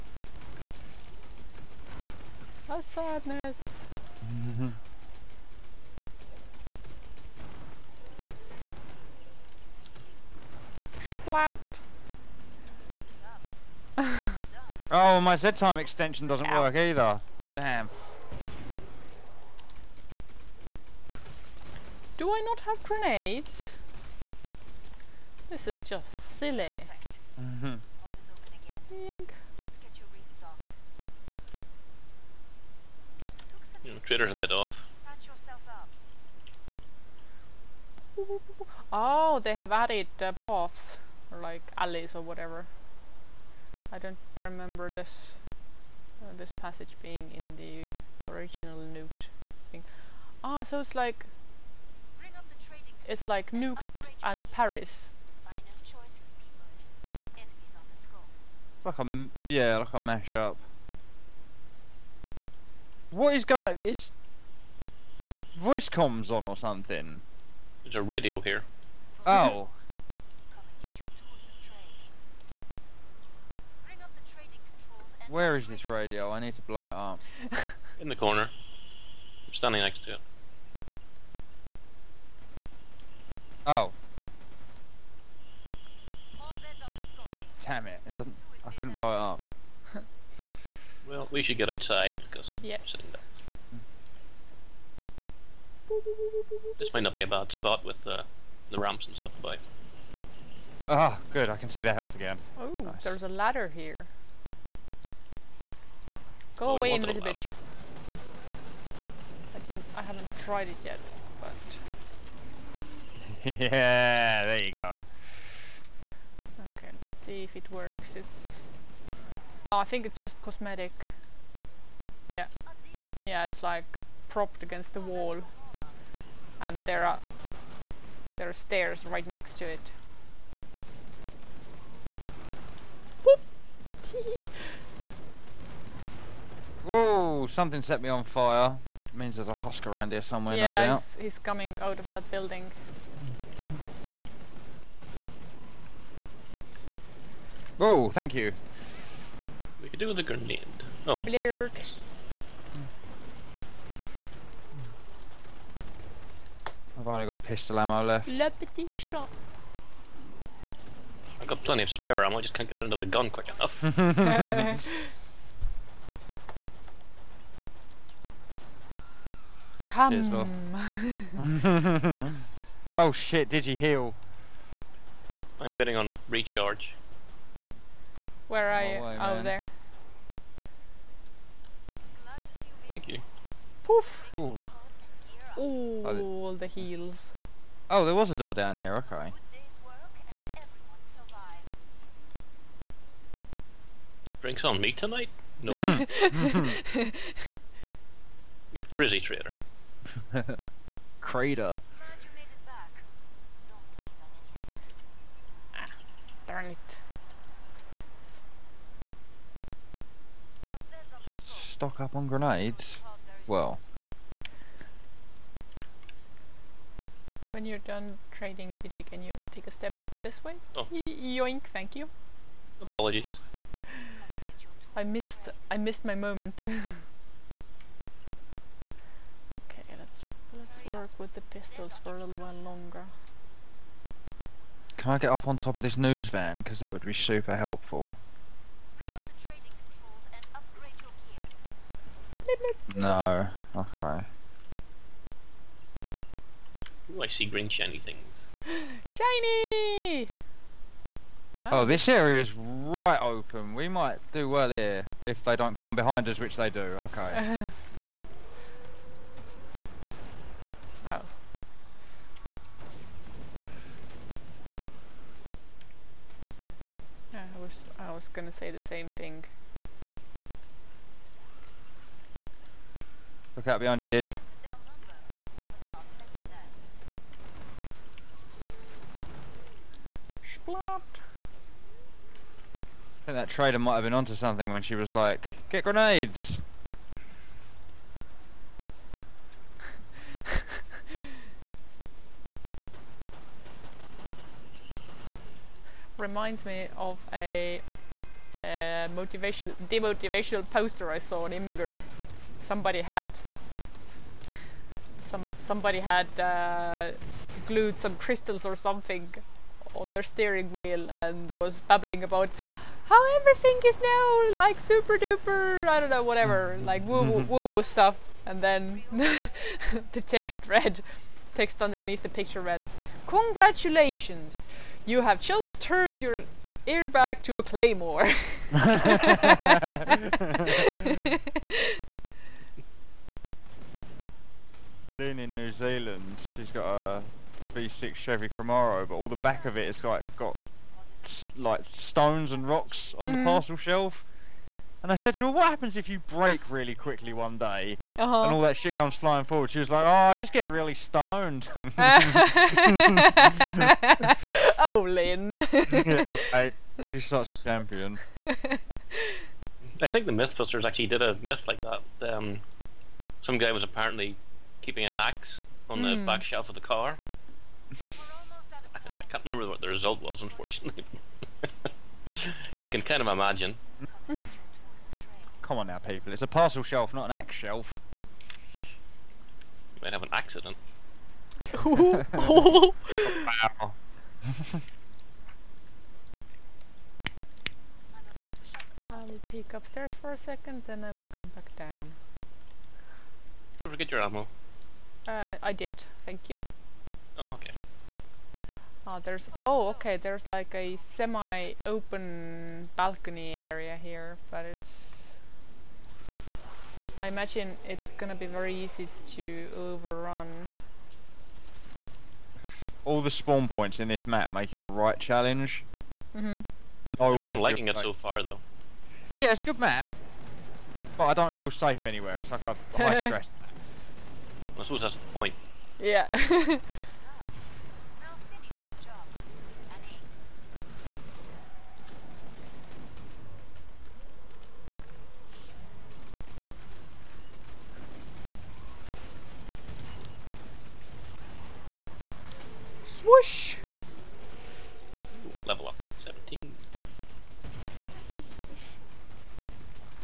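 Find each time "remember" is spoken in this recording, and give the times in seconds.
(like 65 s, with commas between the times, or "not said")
44 s, 369 s.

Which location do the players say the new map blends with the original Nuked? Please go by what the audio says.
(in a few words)
Paris.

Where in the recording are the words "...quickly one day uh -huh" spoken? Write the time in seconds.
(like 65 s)
346 s.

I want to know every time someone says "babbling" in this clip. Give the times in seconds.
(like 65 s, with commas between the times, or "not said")
311 s.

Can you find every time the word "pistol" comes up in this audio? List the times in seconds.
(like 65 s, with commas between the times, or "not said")
157 s, 231 s.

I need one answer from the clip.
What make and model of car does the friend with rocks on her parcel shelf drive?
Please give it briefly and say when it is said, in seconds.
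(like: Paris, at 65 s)
Chevy Camaro, at 338 s.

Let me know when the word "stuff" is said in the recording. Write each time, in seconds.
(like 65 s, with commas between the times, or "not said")
99 s, 317 s.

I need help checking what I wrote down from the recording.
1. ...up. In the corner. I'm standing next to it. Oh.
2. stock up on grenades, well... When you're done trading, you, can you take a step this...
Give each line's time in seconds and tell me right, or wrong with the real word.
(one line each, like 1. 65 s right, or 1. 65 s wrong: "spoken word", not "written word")
1. 76 s right
2. 211 s right.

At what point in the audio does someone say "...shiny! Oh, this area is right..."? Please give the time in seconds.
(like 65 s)
249 s.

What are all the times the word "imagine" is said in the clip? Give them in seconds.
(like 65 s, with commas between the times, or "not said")
373 s, 407 s.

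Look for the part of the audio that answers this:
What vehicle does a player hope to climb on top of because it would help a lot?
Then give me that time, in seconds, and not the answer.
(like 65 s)
235 s.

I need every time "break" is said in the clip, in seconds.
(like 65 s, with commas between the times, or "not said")
346 s.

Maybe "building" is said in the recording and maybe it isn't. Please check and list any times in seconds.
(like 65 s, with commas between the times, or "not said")
142 s.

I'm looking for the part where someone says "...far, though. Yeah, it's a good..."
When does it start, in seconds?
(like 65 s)
418 s.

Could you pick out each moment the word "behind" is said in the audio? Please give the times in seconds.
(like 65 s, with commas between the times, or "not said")
255 s, 273 s.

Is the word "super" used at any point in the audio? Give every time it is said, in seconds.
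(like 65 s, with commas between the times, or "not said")
237 s, 314 s.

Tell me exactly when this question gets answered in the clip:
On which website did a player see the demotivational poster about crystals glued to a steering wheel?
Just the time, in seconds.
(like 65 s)
301 s.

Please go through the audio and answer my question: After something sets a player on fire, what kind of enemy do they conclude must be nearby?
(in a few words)
husk.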